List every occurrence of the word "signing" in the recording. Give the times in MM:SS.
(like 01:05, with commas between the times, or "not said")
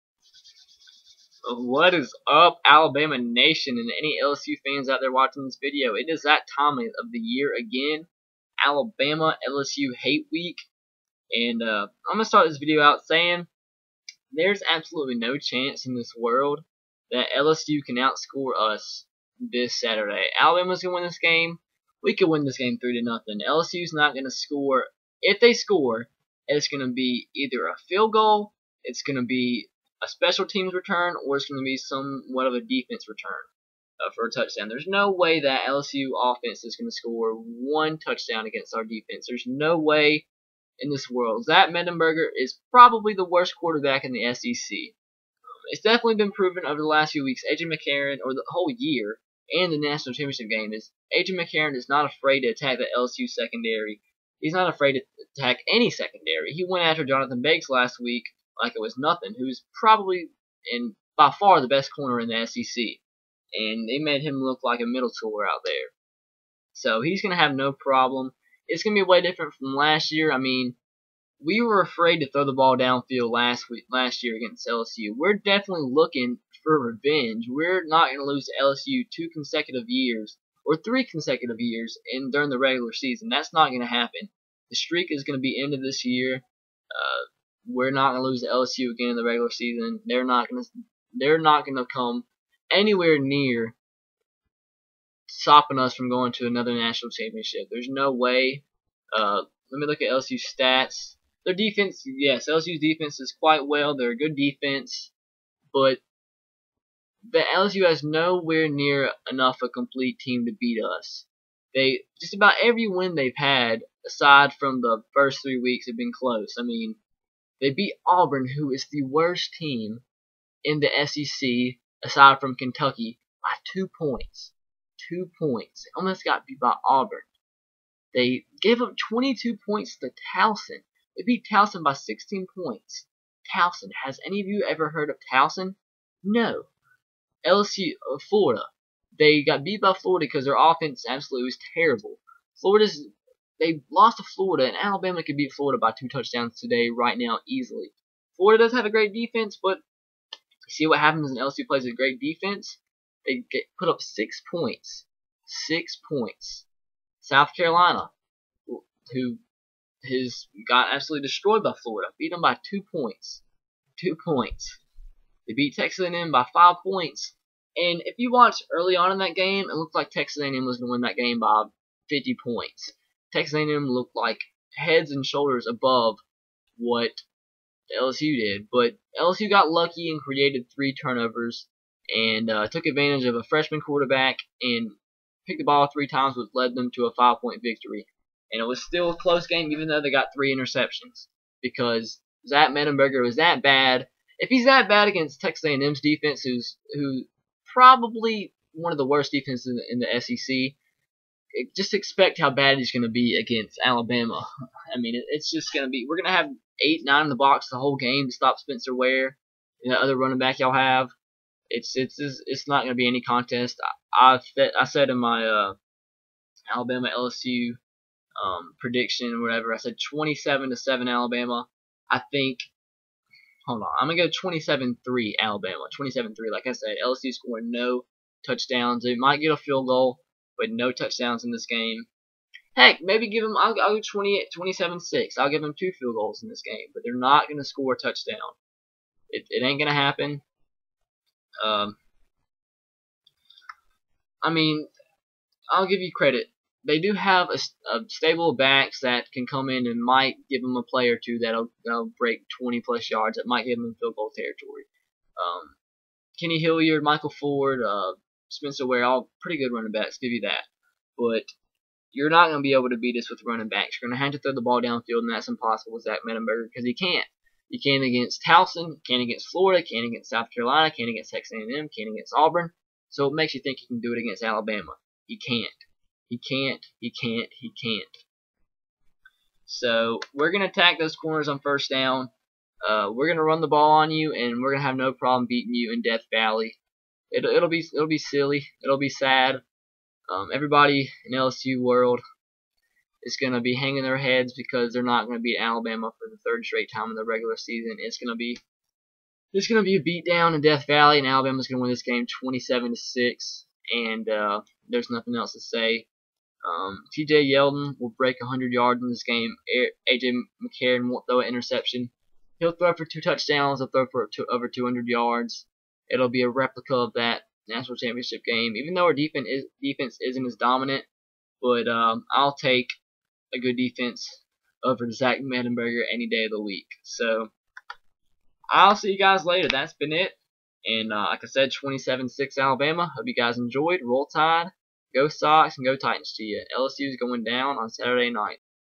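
not said.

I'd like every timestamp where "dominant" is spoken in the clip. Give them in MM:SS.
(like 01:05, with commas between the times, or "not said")
05:20.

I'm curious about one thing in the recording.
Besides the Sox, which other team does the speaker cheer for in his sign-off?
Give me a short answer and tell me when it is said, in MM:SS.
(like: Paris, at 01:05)
Titans, at 05:35.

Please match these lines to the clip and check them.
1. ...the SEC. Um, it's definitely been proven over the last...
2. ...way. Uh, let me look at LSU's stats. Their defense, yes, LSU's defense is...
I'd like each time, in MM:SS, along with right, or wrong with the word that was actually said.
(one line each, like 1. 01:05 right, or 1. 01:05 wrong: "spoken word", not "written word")
1. 00:44 right
2. 01:38 right.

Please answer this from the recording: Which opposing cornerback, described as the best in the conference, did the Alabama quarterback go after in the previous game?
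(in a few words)
Jonathan Banks.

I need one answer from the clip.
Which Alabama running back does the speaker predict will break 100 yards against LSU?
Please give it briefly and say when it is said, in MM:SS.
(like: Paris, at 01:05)
T.J. Yeldon, at 05:07.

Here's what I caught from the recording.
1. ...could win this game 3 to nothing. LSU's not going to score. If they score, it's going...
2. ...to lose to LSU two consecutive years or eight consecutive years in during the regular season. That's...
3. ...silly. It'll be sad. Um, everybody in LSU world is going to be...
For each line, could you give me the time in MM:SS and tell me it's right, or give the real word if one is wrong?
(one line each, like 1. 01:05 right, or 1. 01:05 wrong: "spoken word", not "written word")
1. 00:22 right
2. 01:18 wrong: "three", not "eight"
3. 04:48 right.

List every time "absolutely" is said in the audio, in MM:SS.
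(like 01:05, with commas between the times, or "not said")
00:14, 02:21, 02:40.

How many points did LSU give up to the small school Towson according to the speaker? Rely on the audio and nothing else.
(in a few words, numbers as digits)
22.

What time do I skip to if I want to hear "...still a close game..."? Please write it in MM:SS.
03:08.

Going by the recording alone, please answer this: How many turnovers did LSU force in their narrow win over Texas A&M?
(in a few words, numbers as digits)
3.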